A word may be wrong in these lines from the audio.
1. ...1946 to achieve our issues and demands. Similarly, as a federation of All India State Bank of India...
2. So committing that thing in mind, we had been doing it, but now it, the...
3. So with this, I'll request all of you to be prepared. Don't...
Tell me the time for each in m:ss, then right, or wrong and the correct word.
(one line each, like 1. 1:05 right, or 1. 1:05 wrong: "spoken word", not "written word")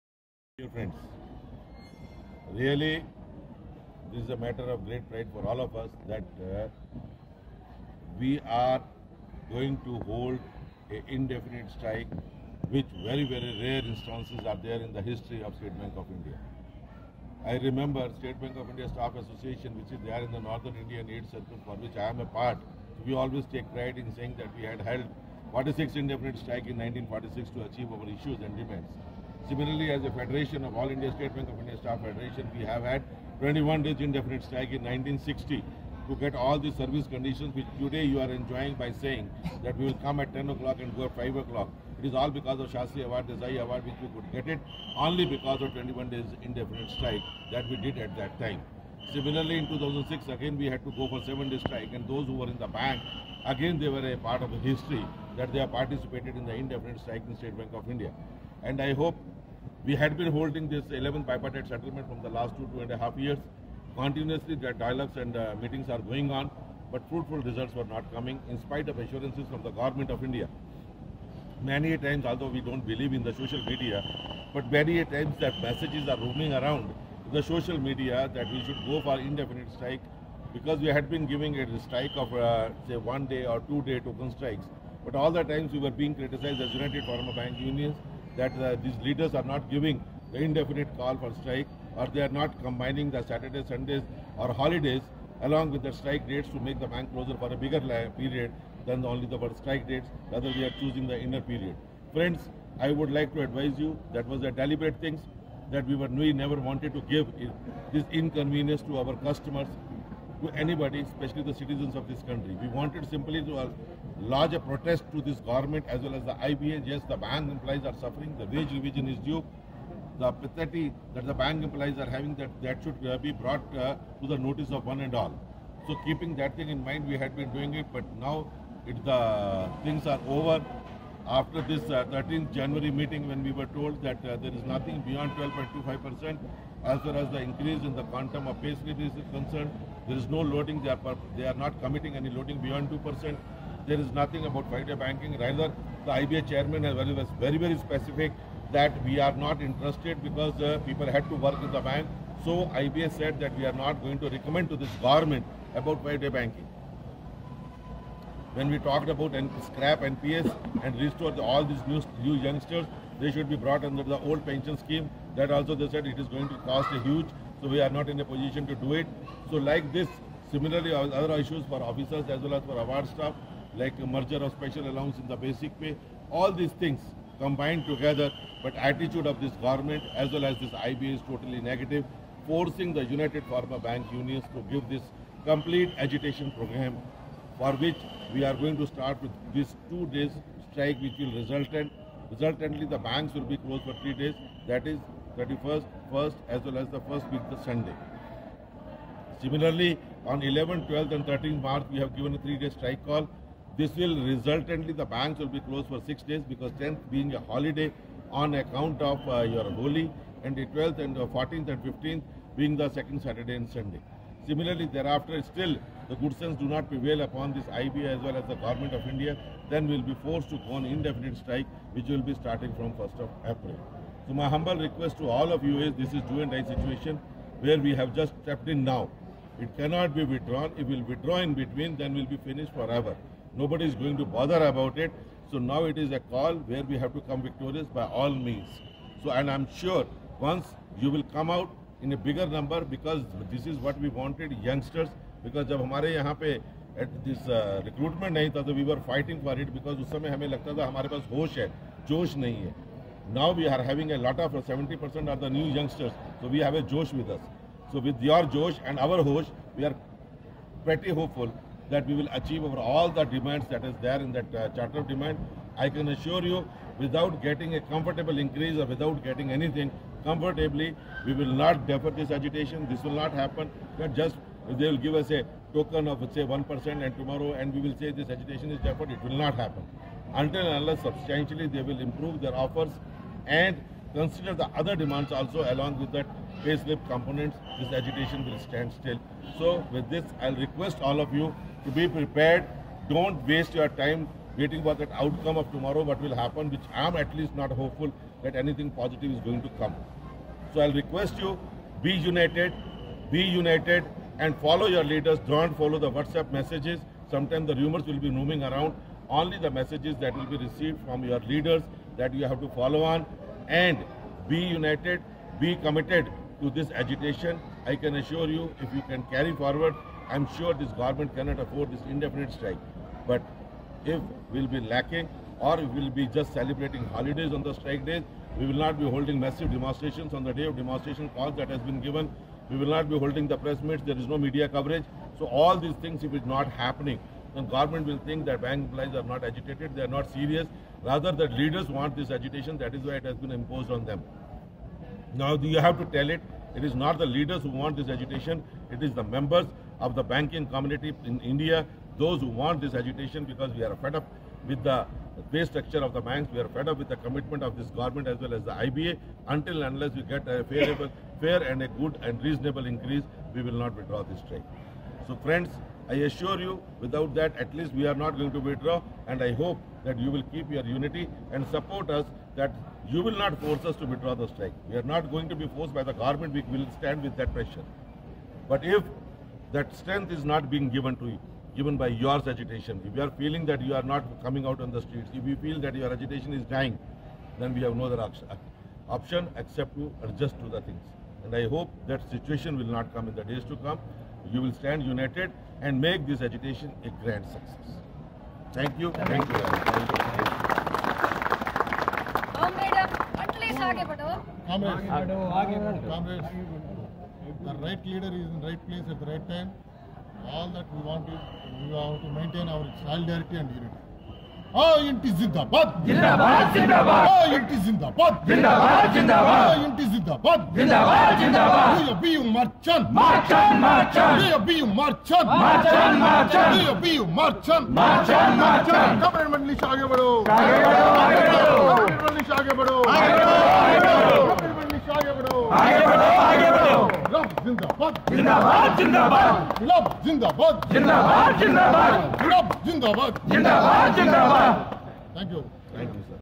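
1. 0:26 right
2. 2:05 wrong: "keeping", not "committing"
3. 4:49 right.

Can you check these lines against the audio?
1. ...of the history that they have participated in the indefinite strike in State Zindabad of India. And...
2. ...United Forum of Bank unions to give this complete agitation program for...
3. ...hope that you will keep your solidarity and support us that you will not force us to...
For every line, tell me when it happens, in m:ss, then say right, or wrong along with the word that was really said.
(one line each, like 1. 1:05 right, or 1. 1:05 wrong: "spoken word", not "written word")
1. 0:54 wrong: "Bank", not "Zindabad"
2. 3:03 right
3. 6:09 wrong: "unity", not "solidarity".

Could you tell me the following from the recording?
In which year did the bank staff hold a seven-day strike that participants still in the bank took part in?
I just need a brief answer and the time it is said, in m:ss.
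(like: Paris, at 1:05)
2006, at 0:49.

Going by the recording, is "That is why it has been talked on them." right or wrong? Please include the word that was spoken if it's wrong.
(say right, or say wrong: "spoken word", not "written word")
wrong: "imposed", not "talked".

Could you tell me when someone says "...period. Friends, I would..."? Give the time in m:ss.
1:41.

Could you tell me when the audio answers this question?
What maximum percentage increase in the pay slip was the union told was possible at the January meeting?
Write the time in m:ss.
2:15.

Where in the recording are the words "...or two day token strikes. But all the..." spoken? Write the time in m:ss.
1:23.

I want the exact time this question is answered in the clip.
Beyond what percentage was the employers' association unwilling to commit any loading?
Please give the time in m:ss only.
2:22.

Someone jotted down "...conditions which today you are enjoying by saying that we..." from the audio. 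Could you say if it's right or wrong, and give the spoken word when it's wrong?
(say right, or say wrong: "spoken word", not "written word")
right.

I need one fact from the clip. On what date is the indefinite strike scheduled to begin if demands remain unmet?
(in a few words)
1st of April.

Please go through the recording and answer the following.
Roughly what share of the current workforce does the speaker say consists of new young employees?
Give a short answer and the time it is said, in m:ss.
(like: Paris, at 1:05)
70%, at 4:14.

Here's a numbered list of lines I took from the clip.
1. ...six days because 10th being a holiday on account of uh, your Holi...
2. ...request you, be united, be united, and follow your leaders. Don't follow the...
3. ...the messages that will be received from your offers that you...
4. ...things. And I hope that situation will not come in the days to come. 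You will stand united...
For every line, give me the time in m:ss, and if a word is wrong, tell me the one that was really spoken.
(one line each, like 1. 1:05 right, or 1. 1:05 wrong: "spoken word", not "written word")
1. 3:26 right
2. 5:00 right
3. 5:09 wrong: "leaders", not "offers"
4. 6:30 right.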